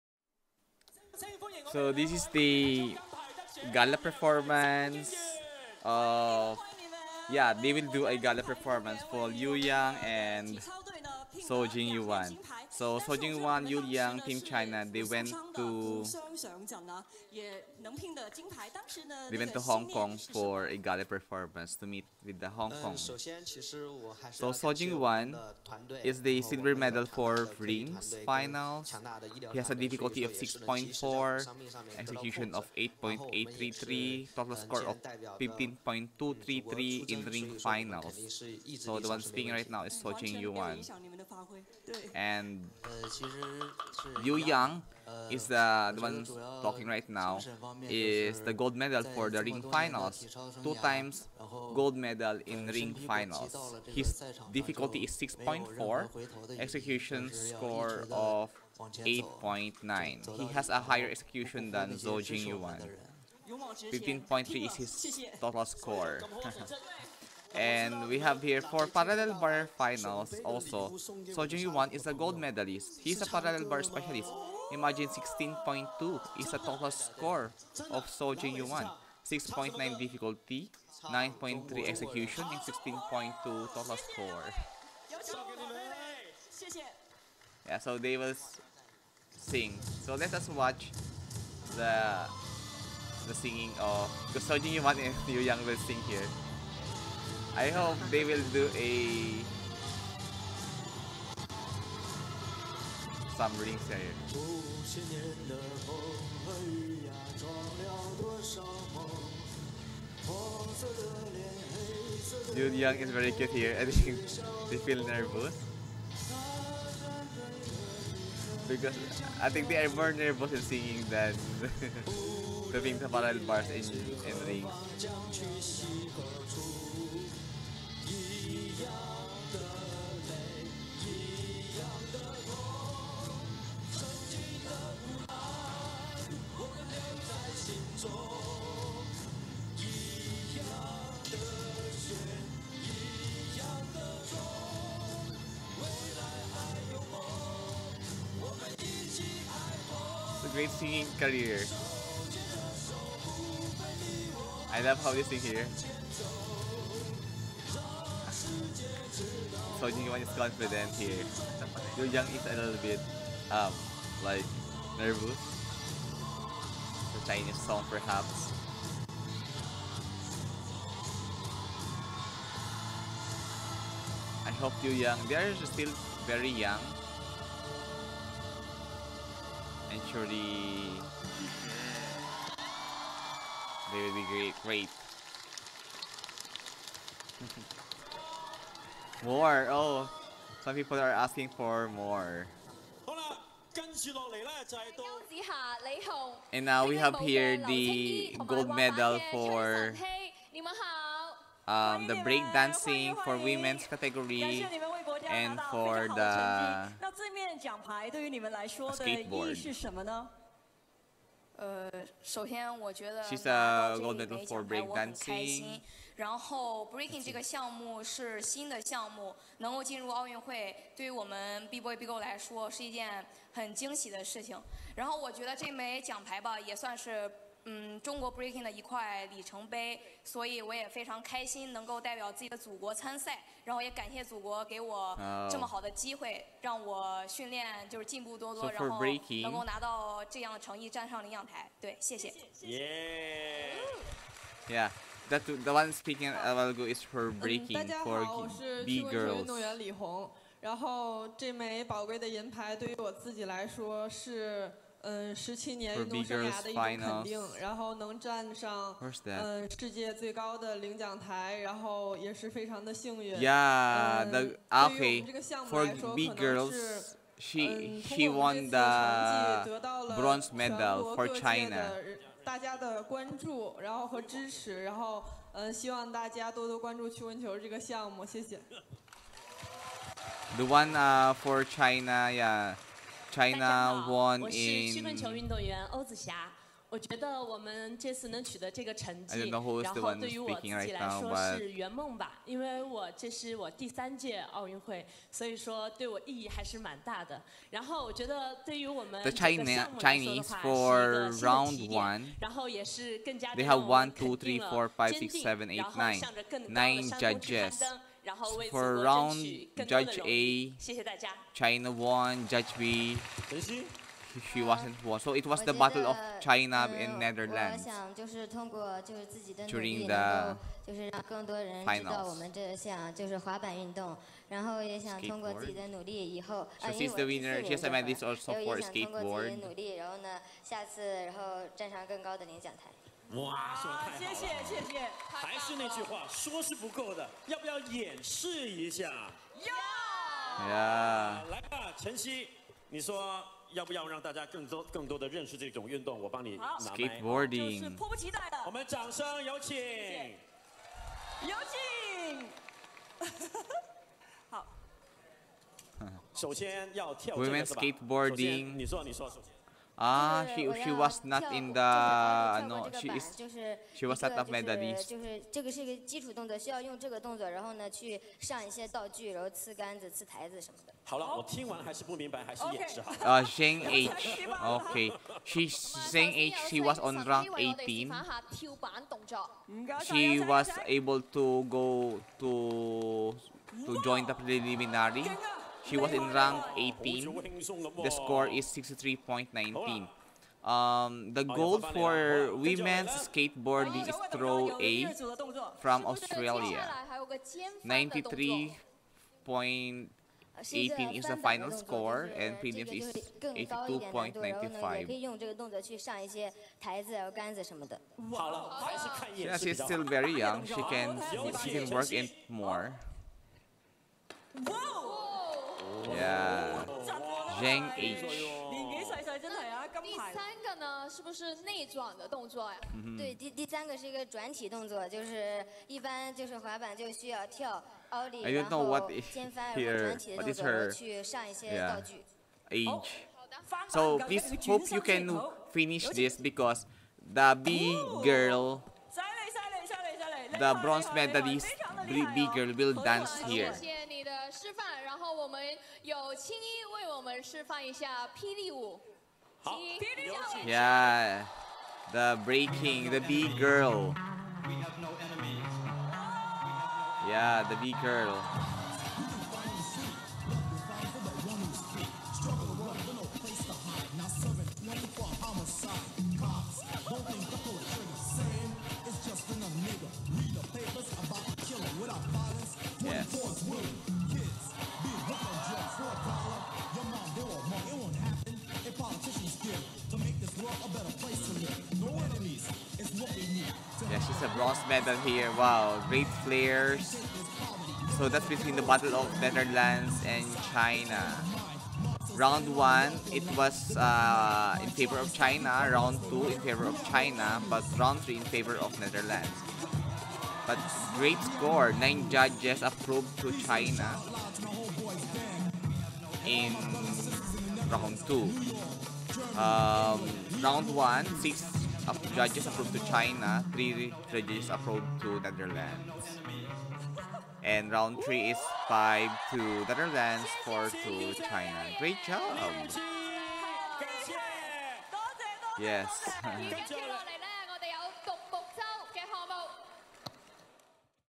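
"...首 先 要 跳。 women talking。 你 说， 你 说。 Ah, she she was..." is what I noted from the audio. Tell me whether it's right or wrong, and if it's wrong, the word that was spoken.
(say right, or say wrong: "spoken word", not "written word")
wrong: "skateboarding", not "talking".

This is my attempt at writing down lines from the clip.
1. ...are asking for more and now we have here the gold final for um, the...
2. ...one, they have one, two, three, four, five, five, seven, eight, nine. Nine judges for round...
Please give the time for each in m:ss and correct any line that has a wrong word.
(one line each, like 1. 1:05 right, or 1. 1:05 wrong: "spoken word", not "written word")
1. 3:10 wrong: "medal", not "final"
2. 5:01 wrong: "six", not "five".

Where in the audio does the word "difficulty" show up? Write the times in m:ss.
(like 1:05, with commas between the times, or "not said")
0:29, 0:54, 1:19.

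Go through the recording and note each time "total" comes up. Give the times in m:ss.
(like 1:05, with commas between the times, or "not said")
0:34, 1:05, 1:16, 1:23.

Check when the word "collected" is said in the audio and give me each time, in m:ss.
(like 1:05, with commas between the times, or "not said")
not said.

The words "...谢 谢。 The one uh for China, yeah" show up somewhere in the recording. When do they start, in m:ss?
4:38.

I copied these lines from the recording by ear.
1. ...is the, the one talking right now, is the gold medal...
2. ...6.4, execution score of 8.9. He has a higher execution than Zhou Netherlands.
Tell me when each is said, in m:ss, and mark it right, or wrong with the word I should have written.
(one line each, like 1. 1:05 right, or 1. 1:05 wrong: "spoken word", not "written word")
1. 0:45 right
2. 0:55 wrong: "Jingyuan", not "Netherlands".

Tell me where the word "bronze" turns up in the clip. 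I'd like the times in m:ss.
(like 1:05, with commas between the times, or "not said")
4:30, 7:20, 8:04.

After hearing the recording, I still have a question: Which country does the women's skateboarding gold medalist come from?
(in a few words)
Australia.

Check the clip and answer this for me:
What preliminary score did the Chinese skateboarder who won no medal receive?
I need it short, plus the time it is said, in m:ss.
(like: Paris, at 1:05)
63.19, at 6:28.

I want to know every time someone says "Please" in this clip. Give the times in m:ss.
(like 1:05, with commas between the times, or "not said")
7:14.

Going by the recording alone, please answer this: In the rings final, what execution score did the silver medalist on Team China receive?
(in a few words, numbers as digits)
8.833.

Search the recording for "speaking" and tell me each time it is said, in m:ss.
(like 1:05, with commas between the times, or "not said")
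0:39, 4:05, 4:50.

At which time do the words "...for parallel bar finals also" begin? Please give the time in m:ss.
1:08.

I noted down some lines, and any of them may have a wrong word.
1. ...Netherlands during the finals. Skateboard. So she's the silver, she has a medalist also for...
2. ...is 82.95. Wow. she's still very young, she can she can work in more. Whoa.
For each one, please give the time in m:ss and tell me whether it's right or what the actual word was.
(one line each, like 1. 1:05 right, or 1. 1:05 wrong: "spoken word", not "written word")
1. 5:17 wrong: "winner", not "silver"
2. 6:42 right.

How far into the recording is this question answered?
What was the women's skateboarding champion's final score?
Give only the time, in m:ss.
6:37.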